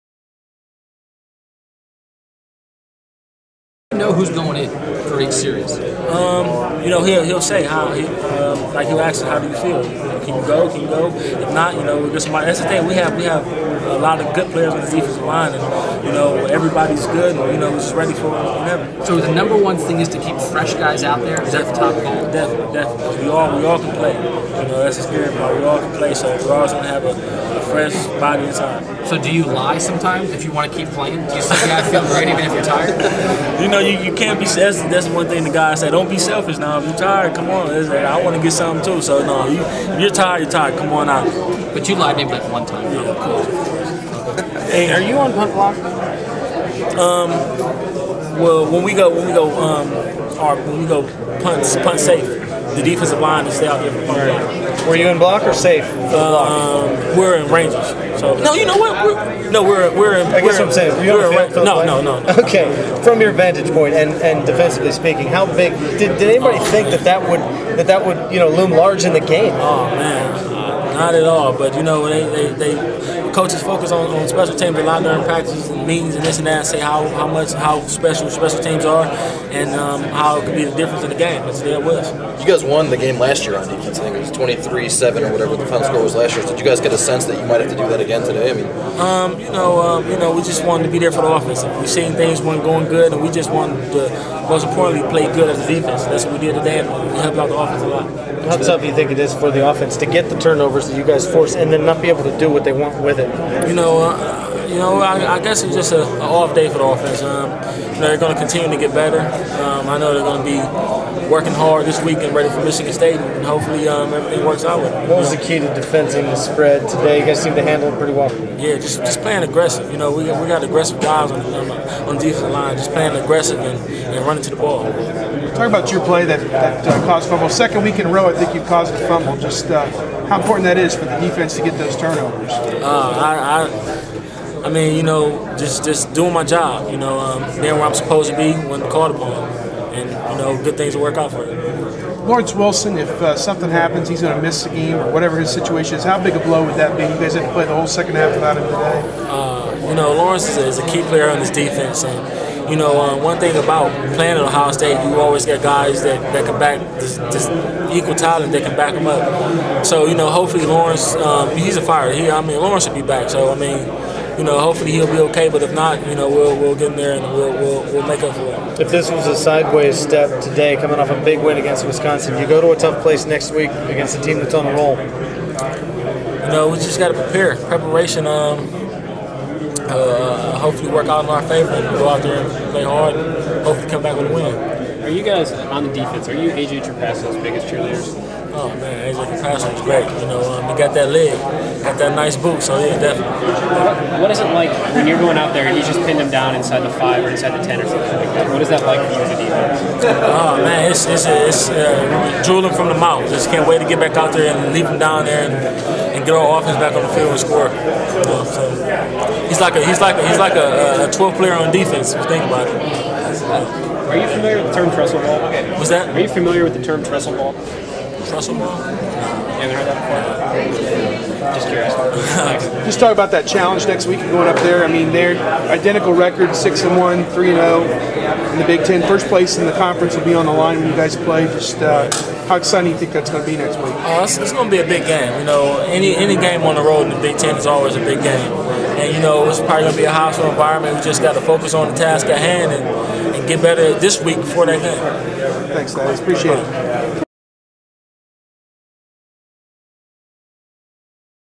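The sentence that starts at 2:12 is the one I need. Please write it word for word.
Uh, I, I, I, mean, you know, just just doing my job.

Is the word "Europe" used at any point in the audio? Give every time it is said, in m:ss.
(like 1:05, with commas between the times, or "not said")
not said.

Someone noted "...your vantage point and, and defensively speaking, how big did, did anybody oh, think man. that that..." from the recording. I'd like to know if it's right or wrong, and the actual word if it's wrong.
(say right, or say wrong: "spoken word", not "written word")
right.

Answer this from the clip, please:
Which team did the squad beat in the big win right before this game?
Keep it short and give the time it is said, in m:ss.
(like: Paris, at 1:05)
Wisconsin, at 2:51.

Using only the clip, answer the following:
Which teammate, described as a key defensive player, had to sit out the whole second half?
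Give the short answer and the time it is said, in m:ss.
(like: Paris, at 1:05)
Lawrence Wilson, at 2:22.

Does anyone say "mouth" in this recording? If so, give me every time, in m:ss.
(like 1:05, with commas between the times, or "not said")
3:22.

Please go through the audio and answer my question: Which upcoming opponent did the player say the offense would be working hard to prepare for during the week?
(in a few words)
Michigan State.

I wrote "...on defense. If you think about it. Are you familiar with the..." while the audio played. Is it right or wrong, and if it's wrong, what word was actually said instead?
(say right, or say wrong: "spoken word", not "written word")
right.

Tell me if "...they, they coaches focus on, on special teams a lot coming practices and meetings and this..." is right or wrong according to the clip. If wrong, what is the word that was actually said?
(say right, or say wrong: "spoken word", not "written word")
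wrong: "during", not "coming".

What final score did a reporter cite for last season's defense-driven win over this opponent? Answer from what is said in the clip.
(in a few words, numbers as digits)
23-7.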